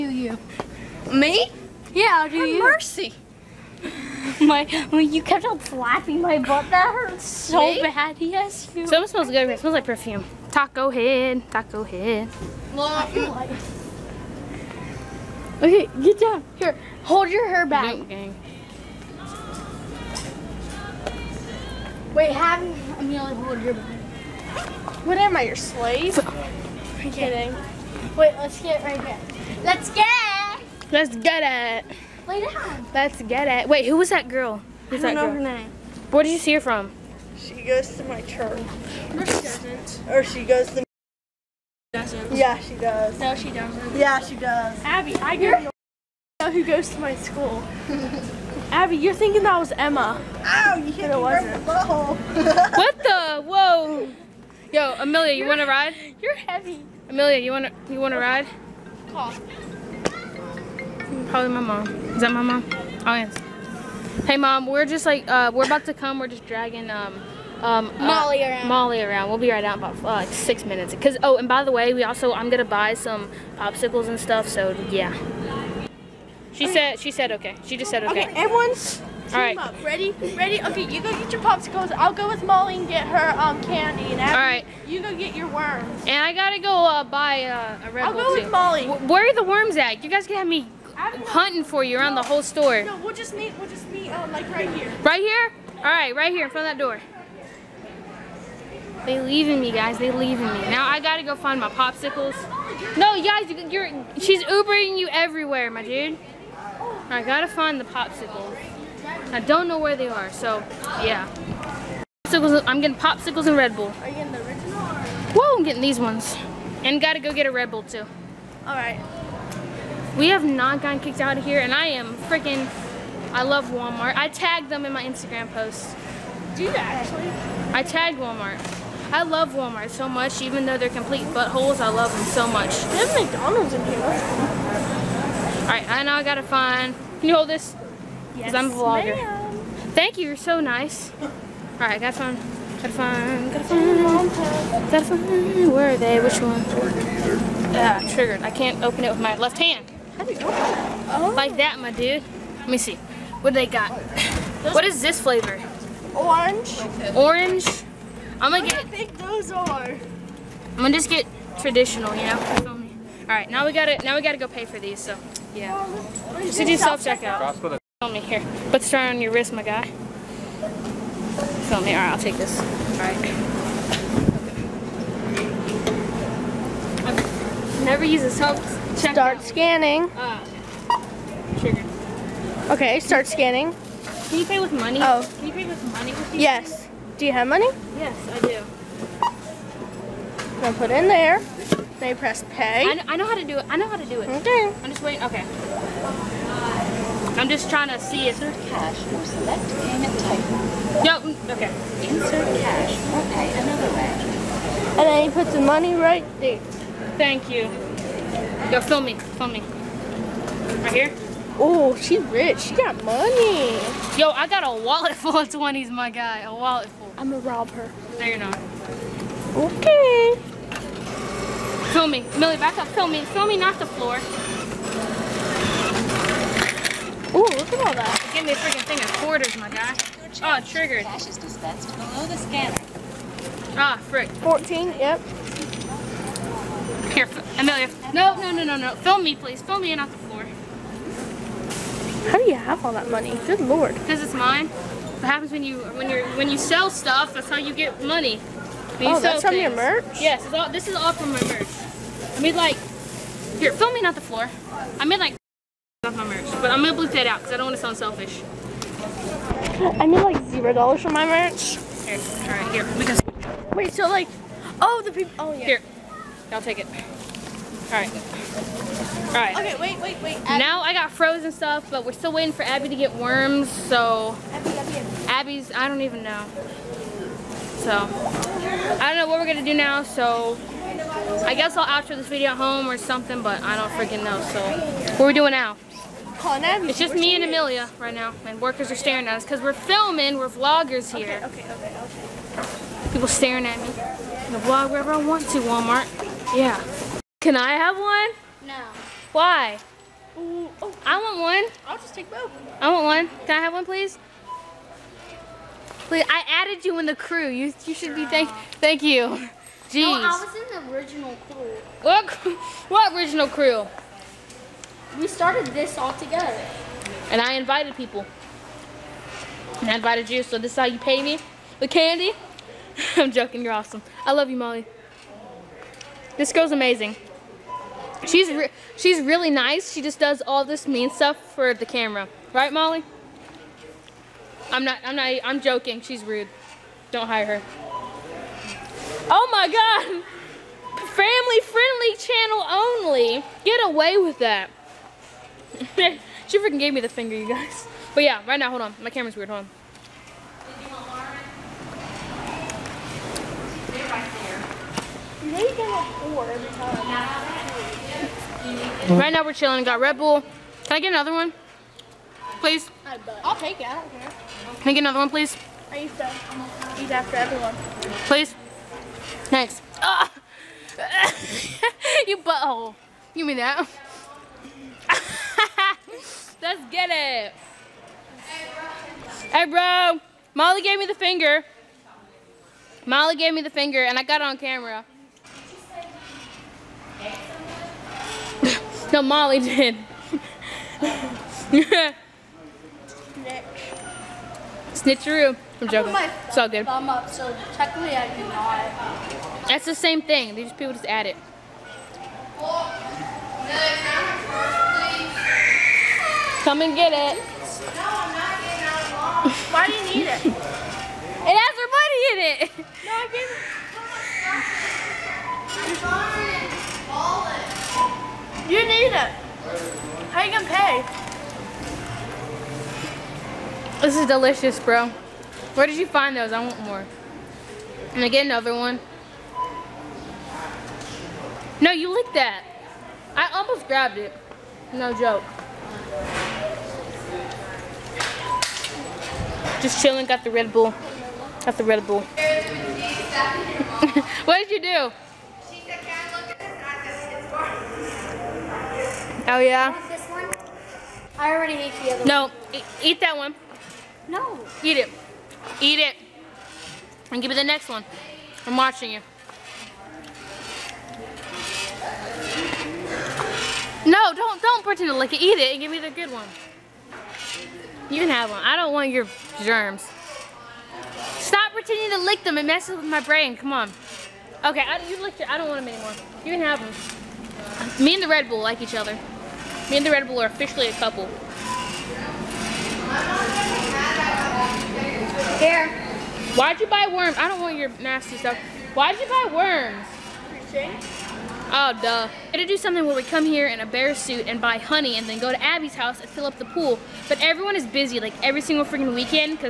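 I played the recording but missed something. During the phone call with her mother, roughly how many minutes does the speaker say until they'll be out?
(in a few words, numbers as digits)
6.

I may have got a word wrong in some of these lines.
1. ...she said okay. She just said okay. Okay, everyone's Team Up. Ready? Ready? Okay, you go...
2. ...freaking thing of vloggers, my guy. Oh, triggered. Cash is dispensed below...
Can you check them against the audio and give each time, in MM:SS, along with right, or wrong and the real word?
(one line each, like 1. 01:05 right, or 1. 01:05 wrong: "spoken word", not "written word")
1. 01:16 right
2. 03:48 wrong: "quarters", not "vloggers".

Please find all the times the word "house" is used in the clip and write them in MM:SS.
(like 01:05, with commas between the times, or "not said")
08:15.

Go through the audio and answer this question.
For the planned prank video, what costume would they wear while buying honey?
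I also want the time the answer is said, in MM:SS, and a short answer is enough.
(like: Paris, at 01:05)
Bear suit, at 08:13.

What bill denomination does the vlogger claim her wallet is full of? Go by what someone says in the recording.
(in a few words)
20s.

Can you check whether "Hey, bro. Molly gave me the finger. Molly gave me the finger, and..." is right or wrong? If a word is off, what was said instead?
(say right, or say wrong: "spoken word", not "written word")
right.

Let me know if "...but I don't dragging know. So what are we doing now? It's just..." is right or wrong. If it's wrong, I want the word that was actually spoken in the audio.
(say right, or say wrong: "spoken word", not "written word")
wrong: "freaking", not "dragging".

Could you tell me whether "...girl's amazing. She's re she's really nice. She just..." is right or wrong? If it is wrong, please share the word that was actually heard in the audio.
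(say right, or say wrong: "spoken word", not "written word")
right.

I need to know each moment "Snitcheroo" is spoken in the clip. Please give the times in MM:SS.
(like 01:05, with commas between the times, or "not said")
06:34.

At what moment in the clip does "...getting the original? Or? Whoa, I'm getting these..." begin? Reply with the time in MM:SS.
01:54.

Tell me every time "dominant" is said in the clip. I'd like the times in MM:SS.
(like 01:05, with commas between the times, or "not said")
not said.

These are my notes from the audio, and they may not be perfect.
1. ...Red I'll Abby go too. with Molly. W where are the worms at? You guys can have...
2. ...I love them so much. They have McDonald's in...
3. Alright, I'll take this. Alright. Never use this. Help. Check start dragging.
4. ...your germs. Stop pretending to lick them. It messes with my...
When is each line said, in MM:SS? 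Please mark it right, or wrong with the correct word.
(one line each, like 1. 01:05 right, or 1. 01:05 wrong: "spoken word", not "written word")
1. 01:27 wrong: "Bull", not "Abby"
2. 02:11 right
3. 02:51 wrong: "scanning", not "dragging"
4. 07:49 right.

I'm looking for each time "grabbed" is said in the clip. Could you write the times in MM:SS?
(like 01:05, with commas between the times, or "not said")
07:13.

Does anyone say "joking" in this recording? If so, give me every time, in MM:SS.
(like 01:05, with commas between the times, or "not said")
05:23, 05:35, 06:35.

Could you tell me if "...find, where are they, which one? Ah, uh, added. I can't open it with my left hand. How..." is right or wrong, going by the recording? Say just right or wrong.
wrong.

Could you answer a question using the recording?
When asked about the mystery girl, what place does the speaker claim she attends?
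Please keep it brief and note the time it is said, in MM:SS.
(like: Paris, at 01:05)
Church, at 00:37.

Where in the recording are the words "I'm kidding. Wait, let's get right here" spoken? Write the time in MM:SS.
00:26.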